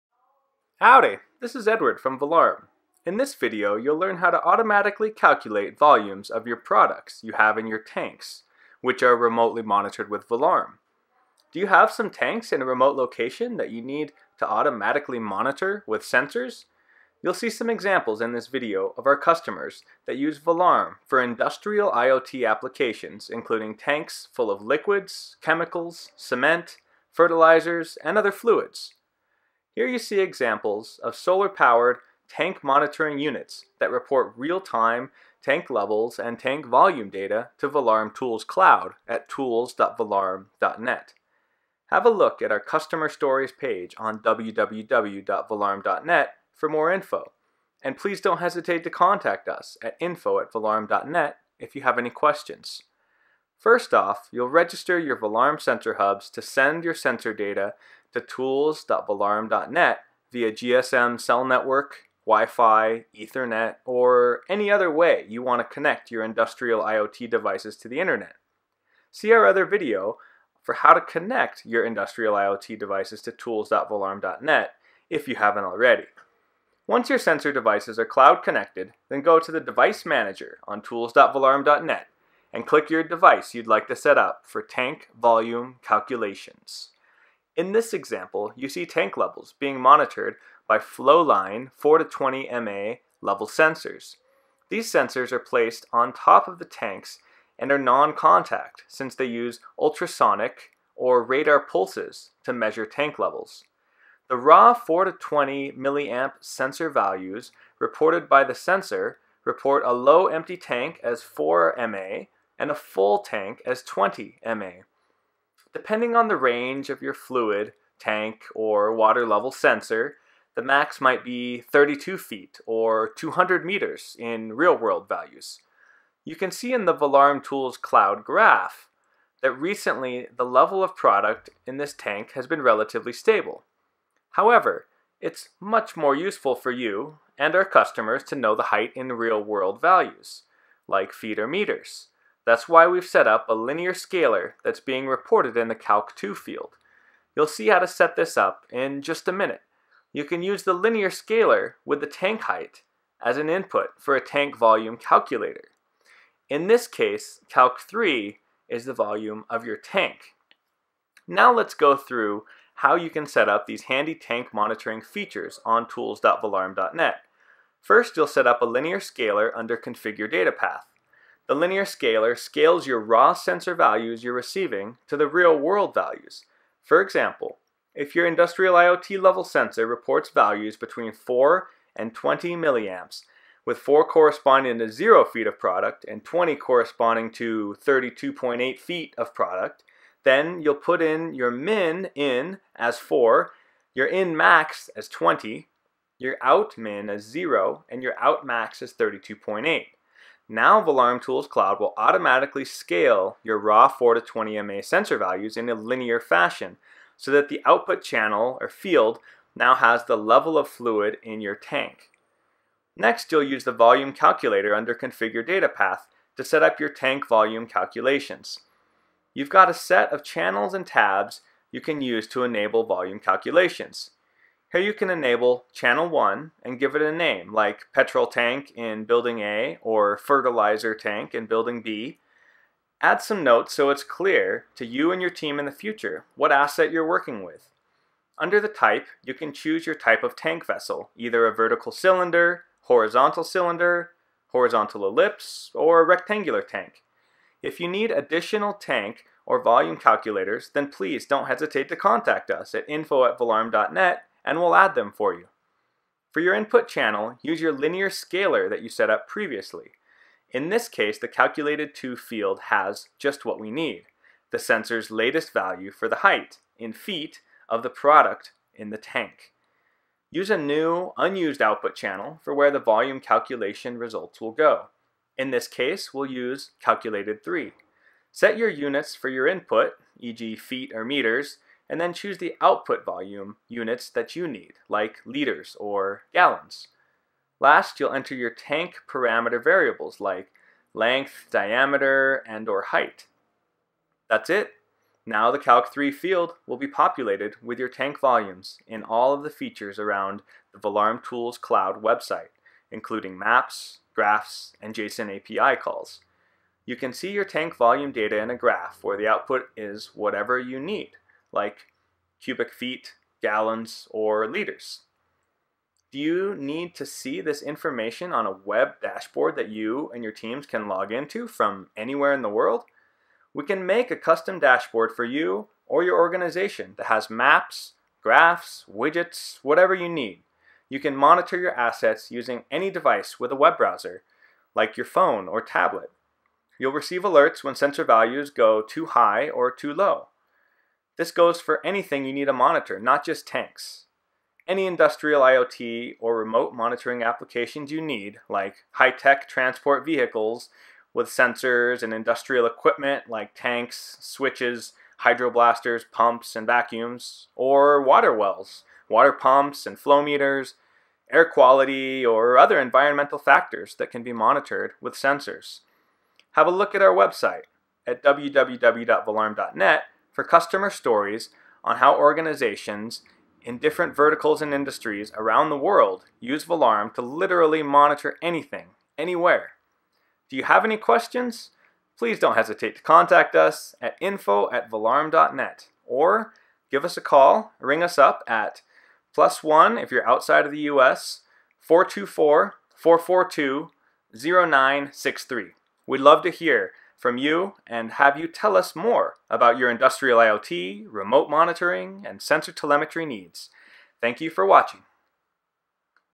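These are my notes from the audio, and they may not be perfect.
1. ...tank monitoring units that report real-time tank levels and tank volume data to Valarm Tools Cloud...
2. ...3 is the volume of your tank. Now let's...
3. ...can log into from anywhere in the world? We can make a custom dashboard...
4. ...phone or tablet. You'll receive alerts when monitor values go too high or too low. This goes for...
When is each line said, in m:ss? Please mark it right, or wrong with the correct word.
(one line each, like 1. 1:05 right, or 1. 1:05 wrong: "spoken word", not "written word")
1. 0:32 right
2. 2:37 right
3. 5:20 right
4. 5:35 wrong: "sensor", not "monitor".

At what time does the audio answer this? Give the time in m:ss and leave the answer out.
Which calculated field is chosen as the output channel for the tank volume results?
4:36.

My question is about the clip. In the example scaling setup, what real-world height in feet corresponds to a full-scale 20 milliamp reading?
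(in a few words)
32.8 feet.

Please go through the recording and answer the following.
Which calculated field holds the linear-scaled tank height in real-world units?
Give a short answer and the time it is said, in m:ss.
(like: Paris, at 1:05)
Calc 2, at 2:25.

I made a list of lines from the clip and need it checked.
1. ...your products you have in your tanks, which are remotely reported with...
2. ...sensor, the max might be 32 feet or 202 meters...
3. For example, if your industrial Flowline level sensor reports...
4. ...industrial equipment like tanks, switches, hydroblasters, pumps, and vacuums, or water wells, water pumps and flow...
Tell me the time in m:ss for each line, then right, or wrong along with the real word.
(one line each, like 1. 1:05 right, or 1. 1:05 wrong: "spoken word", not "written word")
1. 0:06 wrong: "monitored", not "reported"
2. 1:59 wrong: "200", not "202"
3. 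2:56 wrong: "IoT", not "Flowline"
4. 5:52 right.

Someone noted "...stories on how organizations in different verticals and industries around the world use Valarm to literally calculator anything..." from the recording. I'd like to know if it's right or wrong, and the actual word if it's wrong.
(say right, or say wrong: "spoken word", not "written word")
wrong: "monitor", not "calculator".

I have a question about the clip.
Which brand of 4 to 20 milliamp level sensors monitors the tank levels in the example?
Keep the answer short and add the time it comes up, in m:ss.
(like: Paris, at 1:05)
Flowline, at 1:30.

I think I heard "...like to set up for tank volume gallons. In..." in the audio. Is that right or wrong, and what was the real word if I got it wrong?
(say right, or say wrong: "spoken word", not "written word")
wrong: "calculations", not "gallons".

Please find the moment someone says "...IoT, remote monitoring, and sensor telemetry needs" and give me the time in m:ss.
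6:40.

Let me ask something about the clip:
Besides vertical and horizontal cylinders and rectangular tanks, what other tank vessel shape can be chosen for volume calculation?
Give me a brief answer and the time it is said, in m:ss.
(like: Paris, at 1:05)
Horizontal ellipse, at 4:04.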